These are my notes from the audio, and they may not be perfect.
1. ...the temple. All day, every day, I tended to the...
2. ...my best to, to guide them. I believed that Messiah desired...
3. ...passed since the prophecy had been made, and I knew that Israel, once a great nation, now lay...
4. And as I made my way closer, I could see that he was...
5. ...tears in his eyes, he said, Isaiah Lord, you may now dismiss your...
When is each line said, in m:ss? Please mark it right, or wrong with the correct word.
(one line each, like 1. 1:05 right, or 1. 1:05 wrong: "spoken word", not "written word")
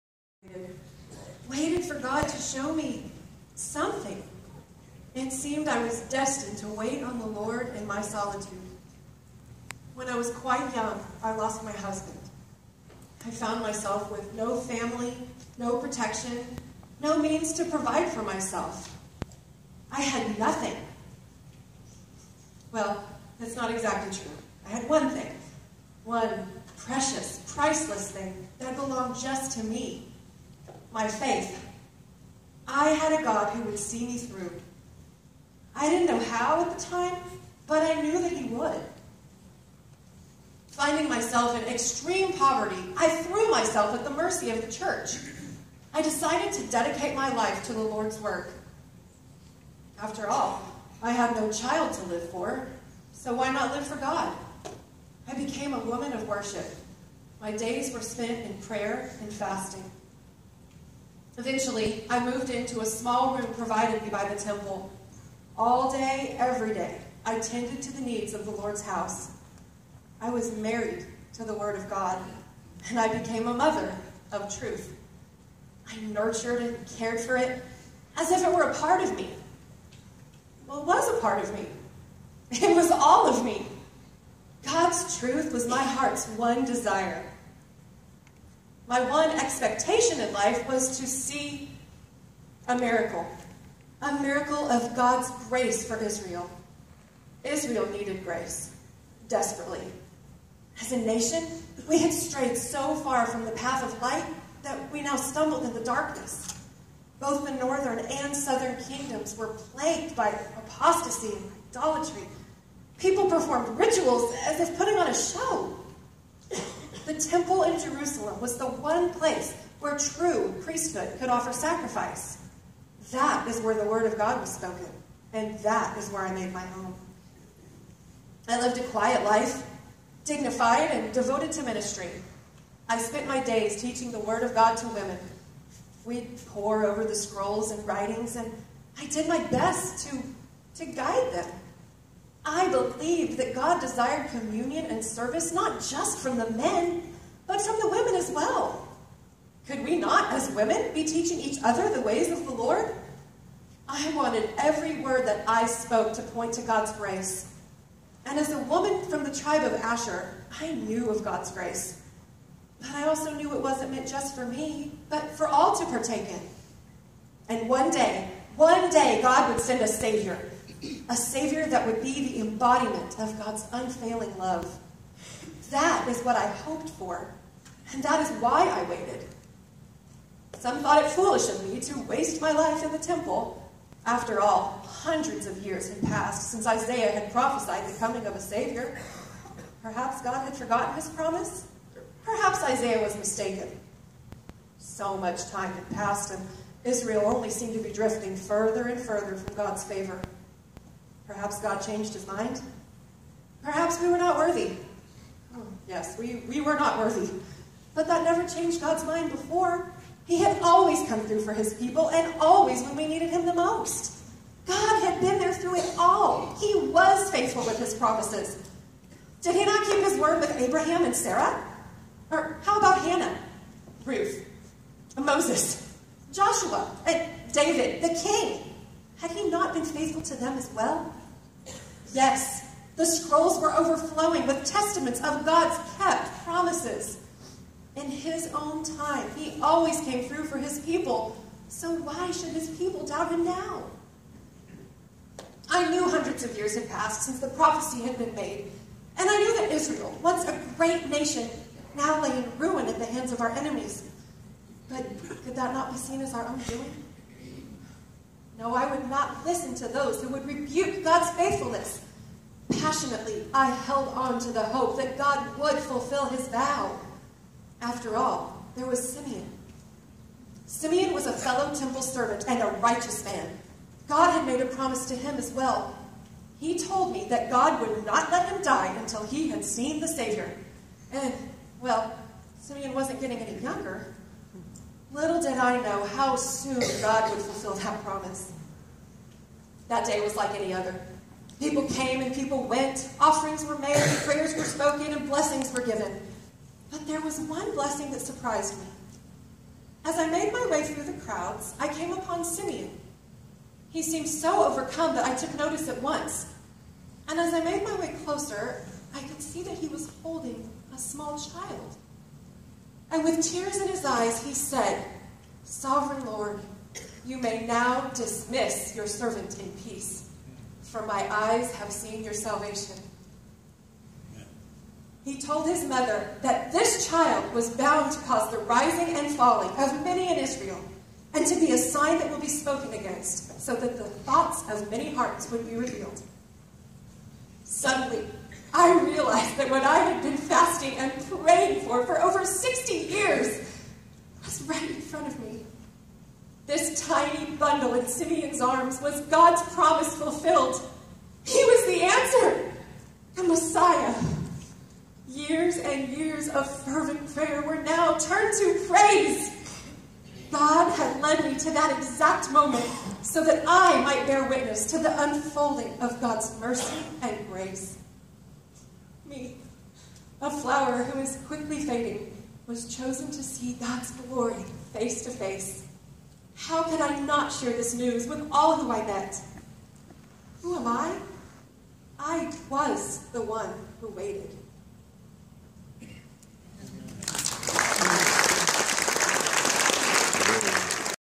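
1. 1:04 right
2. 2:19 wrong: "God", not "Messiah"
3. 4:06 right
4. 5:07 right
5. 5:13 wrong: "Sovereign", not "Isaiah".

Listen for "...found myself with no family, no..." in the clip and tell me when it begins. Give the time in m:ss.
0:13.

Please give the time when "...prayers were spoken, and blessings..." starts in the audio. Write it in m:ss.
4:54.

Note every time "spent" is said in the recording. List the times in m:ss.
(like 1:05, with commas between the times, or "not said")
0:58, 2:12.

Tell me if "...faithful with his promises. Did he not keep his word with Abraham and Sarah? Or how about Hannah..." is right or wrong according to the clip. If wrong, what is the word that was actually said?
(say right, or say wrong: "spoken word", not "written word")
right.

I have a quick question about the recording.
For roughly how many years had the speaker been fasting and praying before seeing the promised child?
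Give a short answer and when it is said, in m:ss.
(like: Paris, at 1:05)
over 60, at 5:42.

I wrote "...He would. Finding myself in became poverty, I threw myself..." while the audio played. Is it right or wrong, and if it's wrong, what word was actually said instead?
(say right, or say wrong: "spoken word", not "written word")
wrong: "extreme", not "became".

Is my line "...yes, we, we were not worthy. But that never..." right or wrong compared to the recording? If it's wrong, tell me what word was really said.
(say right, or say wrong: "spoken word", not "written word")
right.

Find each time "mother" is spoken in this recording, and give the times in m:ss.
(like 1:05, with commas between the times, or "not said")
1:13, 5:25.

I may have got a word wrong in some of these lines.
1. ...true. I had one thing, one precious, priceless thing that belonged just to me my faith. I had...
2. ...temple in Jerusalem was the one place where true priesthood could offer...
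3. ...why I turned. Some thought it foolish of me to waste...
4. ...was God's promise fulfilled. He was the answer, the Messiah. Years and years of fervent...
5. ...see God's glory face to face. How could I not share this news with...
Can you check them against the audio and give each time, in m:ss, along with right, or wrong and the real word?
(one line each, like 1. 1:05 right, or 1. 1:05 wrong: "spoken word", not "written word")
1. 0:24 right
2. 1:57 right
3. 2:58 wrong: "waited", not "turned"
4. 5:49 right
5. 6:13 right.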